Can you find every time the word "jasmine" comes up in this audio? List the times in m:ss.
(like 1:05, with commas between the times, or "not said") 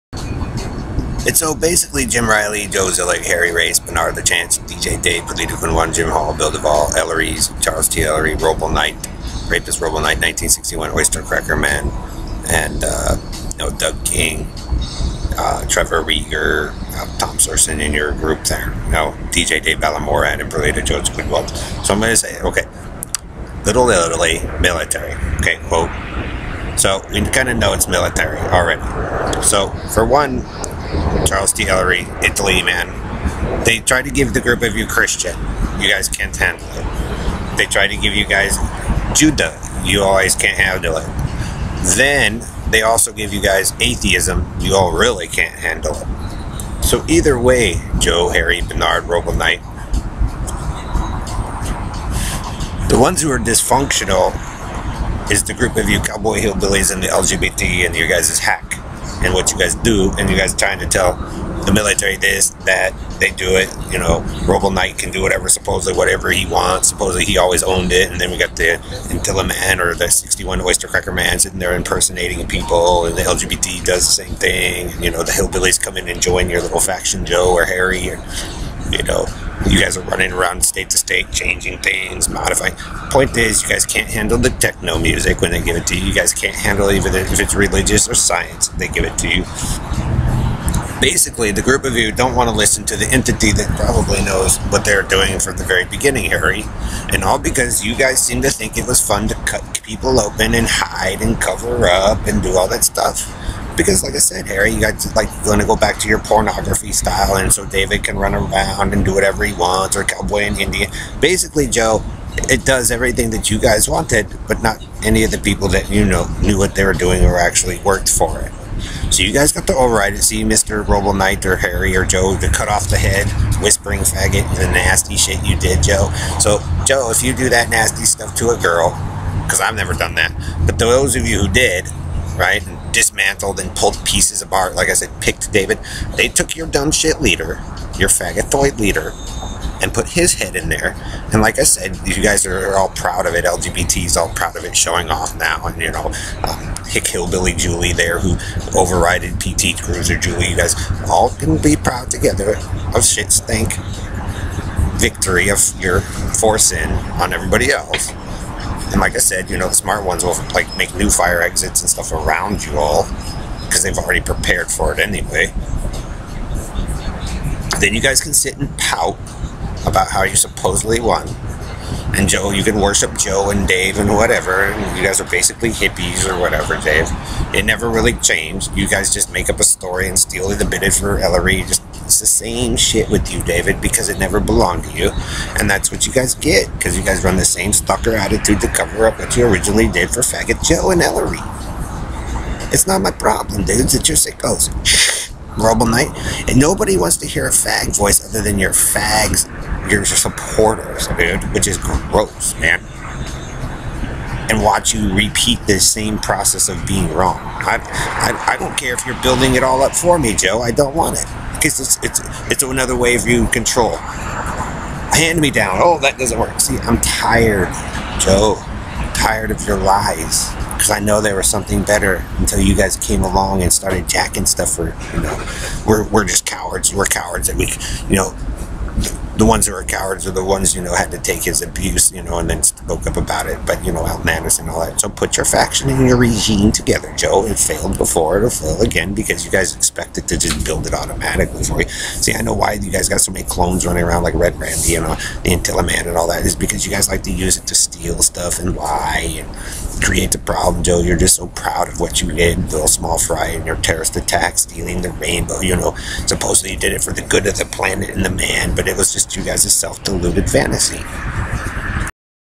not said.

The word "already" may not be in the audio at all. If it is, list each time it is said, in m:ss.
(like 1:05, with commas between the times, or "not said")
0:28, 2:43.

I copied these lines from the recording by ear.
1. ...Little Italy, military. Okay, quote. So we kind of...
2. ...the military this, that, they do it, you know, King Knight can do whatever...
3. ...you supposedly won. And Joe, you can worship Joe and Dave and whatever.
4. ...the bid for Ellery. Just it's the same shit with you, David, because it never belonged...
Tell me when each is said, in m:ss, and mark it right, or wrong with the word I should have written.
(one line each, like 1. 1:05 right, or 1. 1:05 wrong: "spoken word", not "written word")
1. 0:23 right
2. 1:01 wrong: "Robo", not "King"
3. 2:50 right
4. 3:00 right.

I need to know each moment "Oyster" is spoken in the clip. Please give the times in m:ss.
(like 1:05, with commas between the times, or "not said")
0:10, 1:10.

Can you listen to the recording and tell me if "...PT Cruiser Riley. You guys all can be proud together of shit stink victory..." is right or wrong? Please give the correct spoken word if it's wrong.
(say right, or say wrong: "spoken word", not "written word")
wrong: "Julie", not "Riley".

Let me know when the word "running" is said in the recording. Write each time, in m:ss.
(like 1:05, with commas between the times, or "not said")
1:20, 4:03.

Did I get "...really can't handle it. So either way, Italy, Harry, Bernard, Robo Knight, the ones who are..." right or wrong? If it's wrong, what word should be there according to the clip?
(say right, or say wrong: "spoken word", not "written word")
wrong: "Joe", not "Italy".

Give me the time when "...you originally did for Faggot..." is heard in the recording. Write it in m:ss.
3:09.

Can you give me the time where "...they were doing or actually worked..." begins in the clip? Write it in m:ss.
1:56.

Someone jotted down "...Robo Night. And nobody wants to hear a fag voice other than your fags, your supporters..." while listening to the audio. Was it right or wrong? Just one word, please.
right.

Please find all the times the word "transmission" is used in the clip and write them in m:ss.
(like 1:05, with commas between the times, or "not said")
not said.